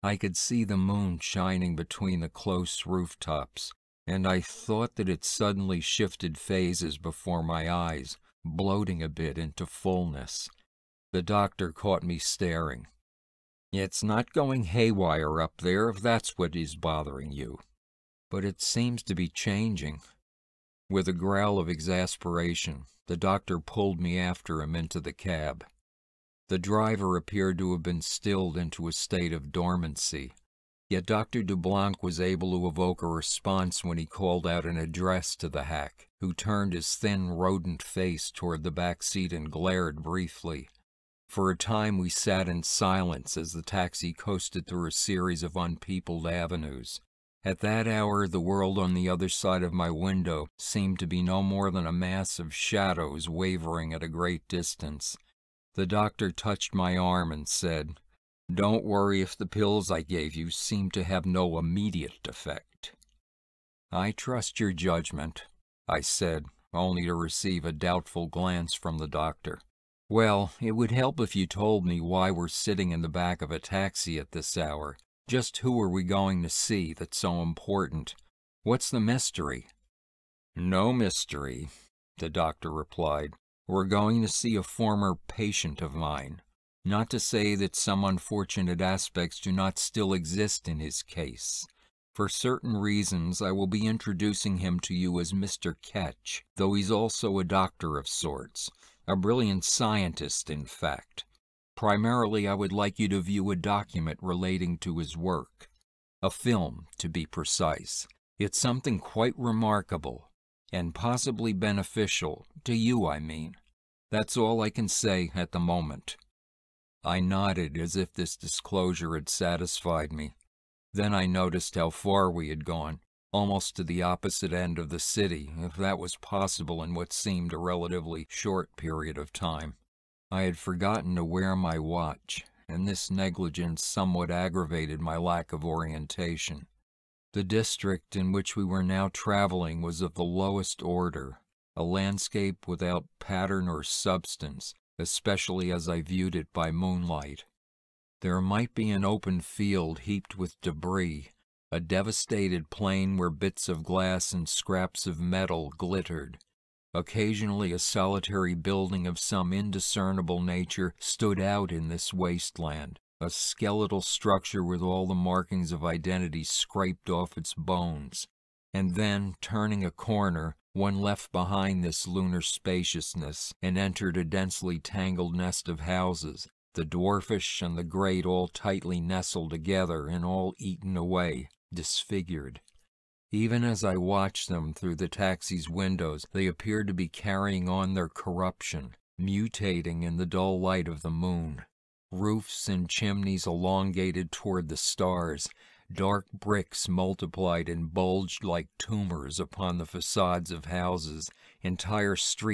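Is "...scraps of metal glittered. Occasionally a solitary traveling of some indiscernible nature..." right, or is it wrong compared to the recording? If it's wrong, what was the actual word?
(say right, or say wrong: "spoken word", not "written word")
wrong: "building", not "traveling".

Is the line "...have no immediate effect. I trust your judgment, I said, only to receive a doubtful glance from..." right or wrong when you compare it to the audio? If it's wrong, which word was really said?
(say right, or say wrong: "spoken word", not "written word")
right.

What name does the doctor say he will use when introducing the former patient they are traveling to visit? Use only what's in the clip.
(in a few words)
Mr. Ketch.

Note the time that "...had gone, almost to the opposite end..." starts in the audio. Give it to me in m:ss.
2:02.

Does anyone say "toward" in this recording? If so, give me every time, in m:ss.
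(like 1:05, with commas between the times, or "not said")
0:38, 3:14.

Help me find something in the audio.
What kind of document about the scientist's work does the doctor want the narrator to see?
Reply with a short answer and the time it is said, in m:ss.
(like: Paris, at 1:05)
A film, at 1:46.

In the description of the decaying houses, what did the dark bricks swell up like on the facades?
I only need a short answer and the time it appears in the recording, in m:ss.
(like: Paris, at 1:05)
Tumors, at 3:18.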